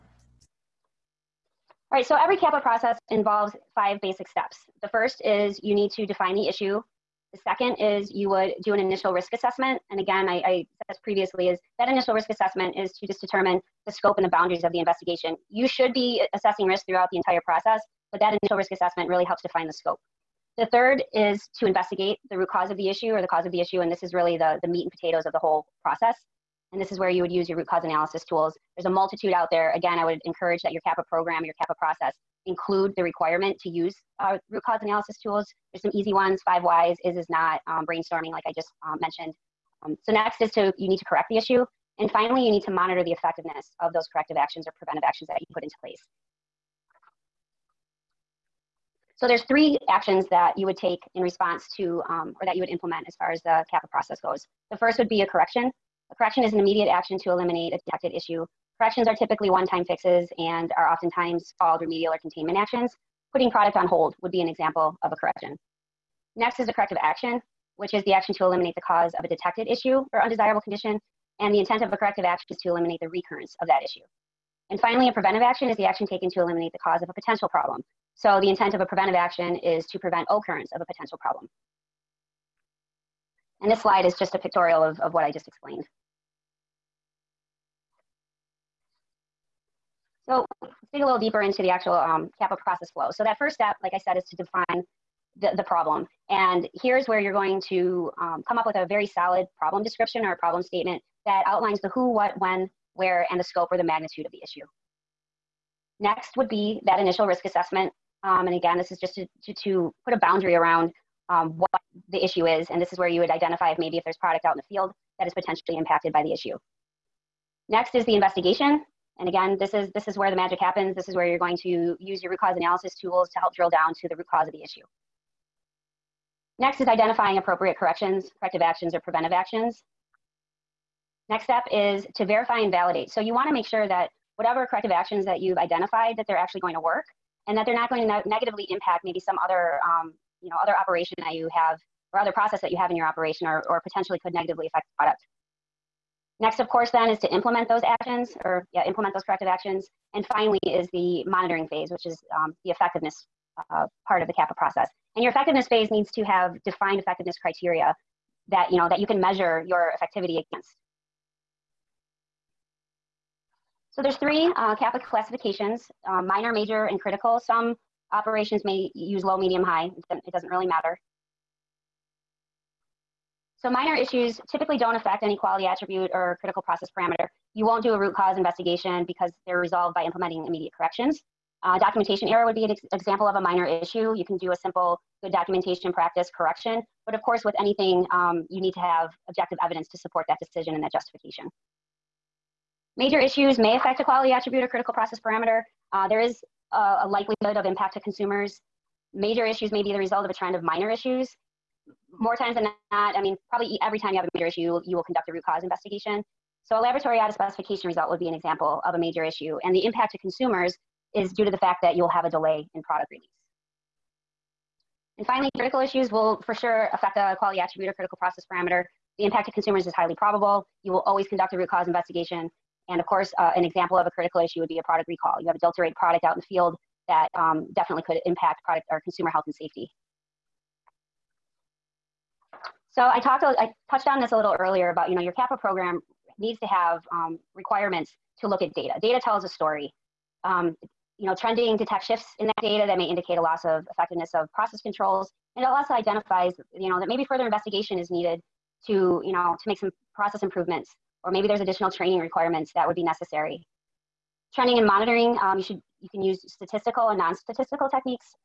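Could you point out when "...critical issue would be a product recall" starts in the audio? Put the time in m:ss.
3:44.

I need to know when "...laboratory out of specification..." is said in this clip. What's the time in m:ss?
3:26.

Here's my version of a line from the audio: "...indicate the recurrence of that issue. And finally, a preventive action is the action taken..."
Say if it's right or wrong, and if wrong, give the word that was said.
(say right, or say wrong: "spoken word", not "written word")
wrong: "eliminate", not "indicate".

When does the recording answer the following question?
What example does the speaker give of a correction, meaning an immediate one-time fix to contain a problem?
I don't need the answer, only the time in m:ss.
1:03.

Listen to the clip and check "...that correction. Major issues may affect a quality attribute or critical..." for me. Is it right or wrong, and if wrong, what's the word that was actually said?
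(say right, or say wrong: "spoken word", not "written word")
wrong: "justification", not "correction".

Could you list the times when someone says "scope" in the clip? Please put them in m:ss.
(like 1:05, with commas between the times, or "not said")
0:13, 0:19, 1:43.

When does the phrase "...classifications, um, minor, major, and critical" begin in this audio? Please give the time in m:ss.
2:45.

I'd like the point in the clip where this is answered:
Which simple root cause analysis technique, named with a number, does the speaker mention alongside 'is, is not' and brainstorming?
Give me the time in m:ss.
0:36.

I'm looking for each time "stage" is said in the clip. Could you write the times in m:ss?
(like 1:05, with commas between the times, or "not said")
not said.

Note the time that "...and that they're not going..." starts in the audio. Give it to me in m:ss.
2:17.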